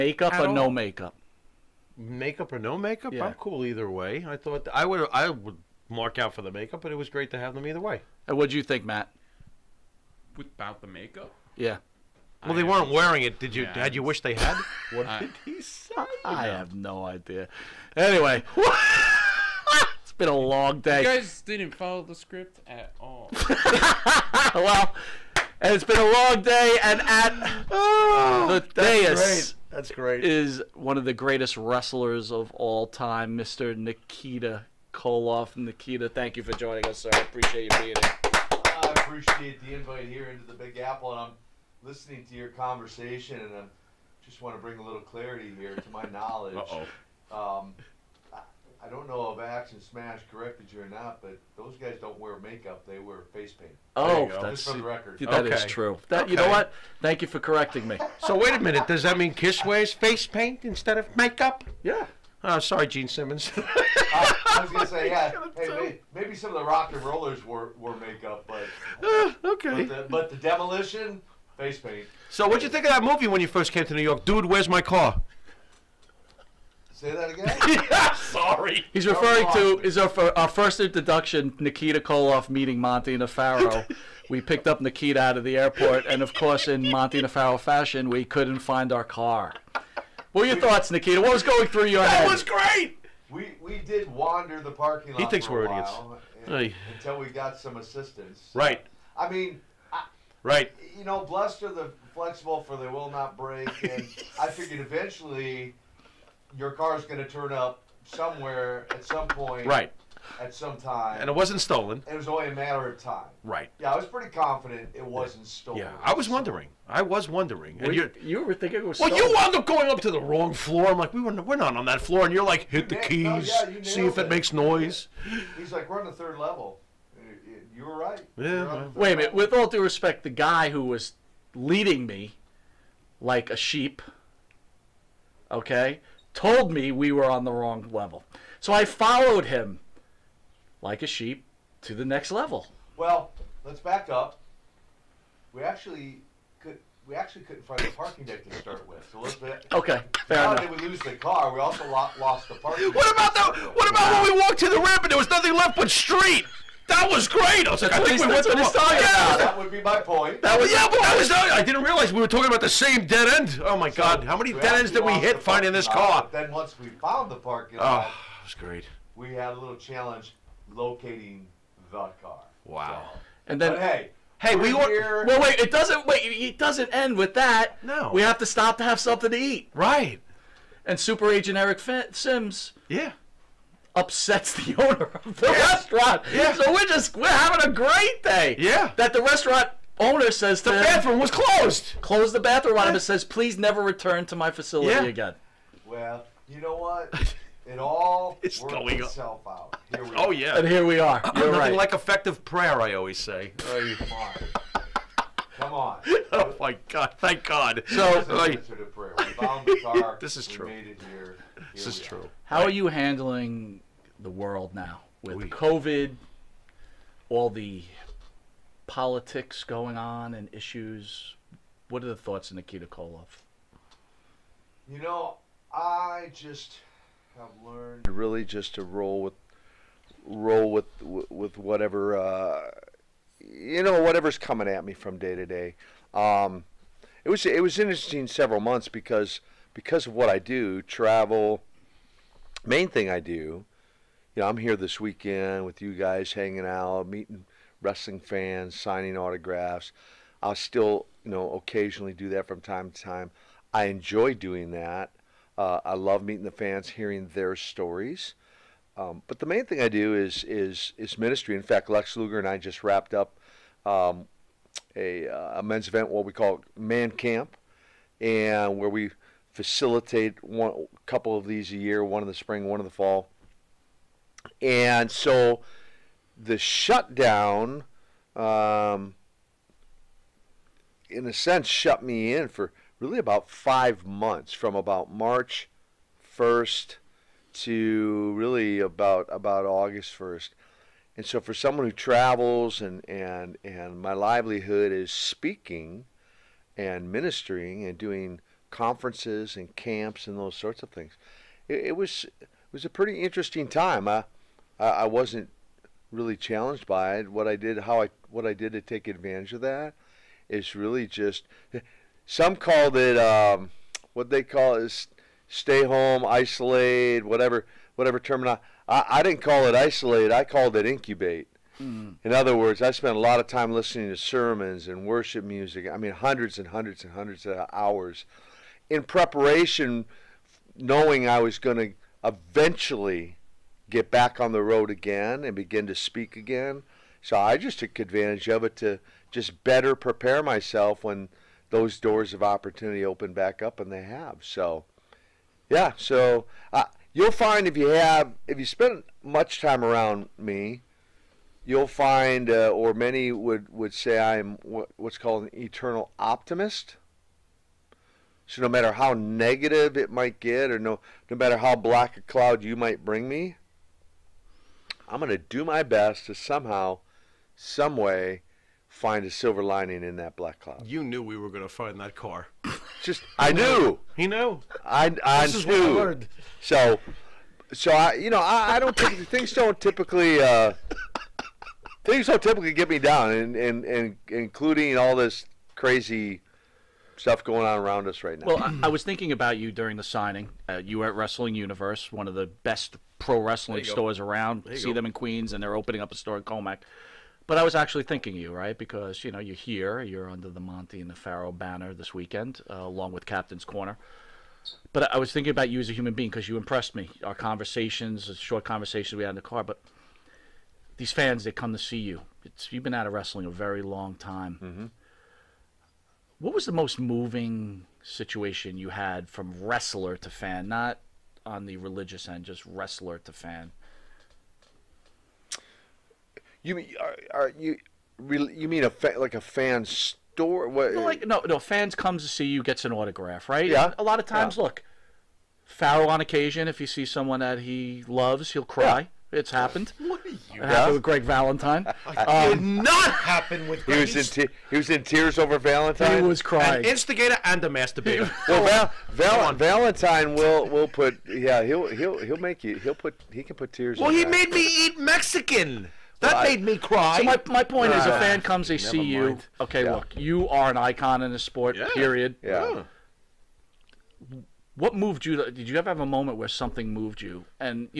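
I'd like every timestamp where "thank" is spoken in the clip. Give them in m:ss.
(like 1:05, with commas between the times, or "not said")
0:36, 0:56, 3:27.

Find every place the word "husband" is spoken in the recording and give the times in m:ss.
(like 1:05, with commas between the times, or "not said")
not said.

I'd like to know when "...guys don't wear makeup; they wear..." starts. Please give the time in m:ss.
0:51.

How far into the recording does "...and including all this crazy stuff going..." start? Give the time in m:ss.
6:23.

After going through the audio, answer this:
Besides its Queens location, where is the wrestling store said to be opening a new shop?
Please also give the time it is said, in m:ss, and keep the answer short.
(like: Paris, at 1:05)
Commack, at 6:36.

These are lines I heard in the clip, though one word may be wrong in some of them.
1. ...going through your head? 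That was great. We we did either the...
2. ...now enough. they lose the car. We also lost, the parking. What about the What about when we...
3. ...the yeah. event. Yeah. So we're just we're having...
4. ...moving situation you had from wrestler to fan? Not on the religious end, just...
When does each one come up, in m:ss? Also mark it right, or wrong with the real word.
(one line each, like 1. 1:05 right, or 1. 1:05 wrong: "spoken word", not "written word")
1. 1:31 wrong: "wander", not "either"
2. 2:30 right
3. 3:05 wrong: "restaurant", not "event"
4. 6:56 right.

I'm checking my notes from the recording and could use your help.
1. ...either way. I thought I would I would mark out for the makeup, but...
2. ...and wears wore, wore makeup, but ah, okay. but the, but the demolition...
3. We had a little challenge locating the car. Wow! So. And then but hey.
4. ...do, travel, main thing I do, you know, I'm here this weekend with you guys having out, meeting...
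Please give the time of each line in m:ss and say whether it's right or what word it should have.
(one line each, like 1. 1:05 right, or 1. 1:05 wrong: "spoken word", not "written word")
1. 0:03 right
2. 1:06 wrong: "rollers", not "wears"
3. 2:49 right
4. 4:00 wrong: "hanging", not "having".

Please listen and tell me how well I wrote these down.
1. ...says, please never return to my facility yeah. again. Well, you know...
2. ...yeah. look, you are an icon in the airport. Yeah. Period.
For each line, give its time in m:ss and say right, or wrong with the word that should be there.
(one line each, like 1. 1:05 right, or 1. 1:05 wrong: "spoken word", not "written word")
1. 3:13 right
2. 7:39 wrong: "sport", not "airport".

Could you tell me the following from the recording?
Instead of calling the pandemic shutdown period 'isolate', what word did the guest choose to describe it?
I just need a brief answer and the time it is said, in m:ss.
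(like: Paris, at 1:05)
Incubate, at 5:20.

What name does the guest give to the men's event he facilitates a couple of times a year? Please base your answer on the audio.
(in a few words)
Man camp.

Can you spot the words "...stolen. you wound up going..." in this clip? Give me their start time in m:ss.
1:59.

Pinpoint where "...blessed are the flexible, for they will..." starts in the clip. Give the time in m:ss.
1:41.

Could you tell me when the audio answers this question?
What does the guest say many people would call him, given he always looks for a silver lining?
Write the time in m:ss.
5:55.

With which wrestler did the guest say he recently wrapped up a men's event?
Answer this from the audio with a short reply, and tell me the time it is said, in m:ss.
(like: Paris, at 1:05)
Lex Luger, at 4:21.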